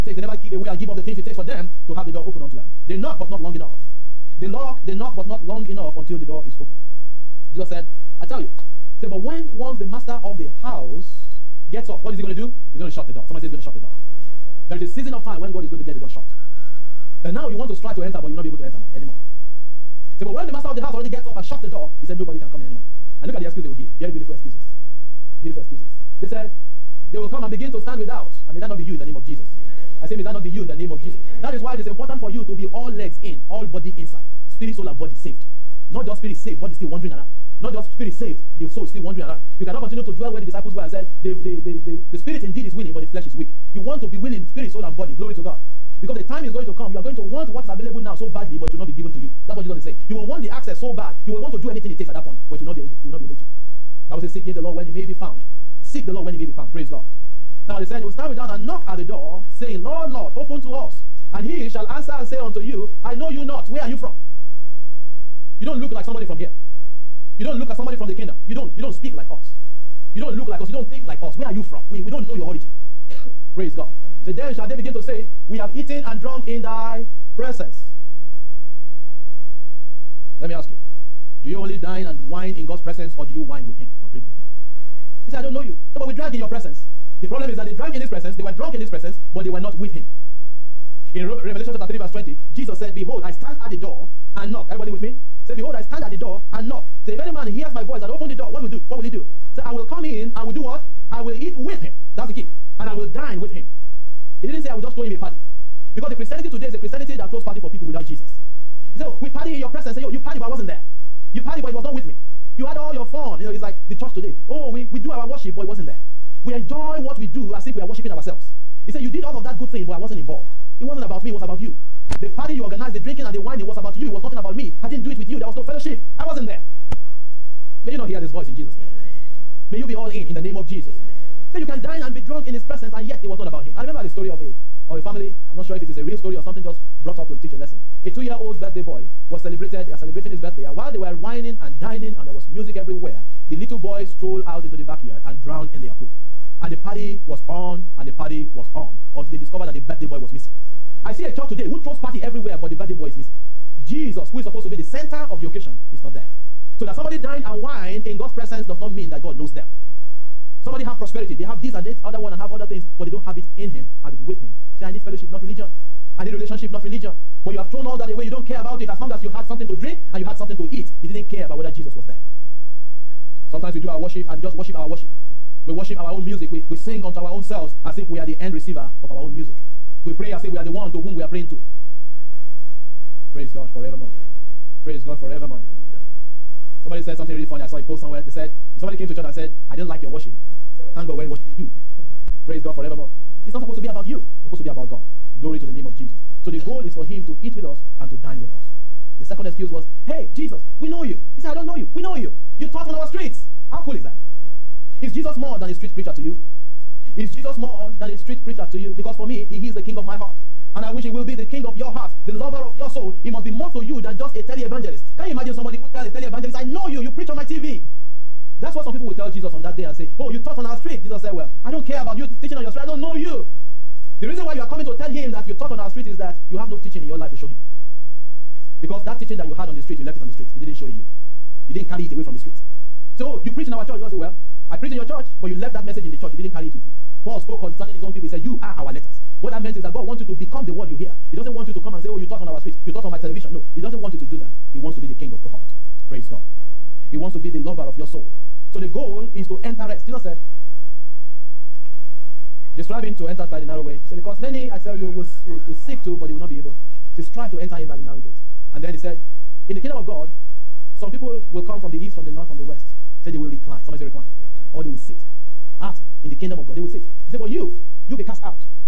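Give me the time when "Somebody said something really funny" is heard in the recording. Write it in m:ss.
3:06.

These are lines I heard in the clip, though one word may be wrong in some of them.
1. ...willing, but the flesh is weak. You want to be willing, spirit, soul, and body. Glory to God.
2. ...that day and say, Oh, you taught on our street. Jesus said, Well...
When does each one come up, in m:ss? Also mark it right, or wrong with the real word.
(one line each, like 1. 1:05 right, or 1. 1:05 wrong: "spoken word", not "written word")
1. 0:42 right
2. 3:39 right.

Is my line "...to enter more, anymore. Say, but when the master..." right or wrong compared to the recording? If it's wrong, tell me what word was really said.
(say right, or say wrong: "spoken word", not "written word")
right.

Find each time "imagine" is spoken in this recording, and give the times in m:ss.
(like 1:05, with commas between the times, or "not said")
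3:35.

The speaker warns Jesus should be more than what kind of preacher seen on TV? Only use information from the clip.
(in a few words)
Tele evangelist.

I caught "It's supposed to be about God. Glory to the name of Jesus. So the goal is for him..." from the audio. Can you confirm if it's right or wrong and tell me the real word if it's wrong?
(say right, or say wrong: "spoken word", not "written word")
right.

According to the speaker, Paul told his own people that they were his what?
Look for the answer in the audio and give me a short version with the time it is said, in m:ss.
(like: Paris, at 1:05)
Letters, at 3:58.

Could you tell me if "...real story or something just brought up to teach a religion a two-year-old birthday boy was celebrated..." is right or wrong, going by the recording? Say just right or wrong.
wrong.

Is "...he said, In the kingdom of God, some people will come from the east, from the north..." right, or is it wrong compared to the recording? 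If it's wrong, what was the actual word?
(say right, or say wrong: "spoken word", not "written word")
right.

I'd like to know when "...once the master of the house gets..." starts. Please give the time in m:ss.
0:09.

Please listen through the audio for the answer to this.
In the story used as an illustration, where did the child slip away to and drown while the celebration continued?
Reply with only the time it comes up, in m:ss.
2:25.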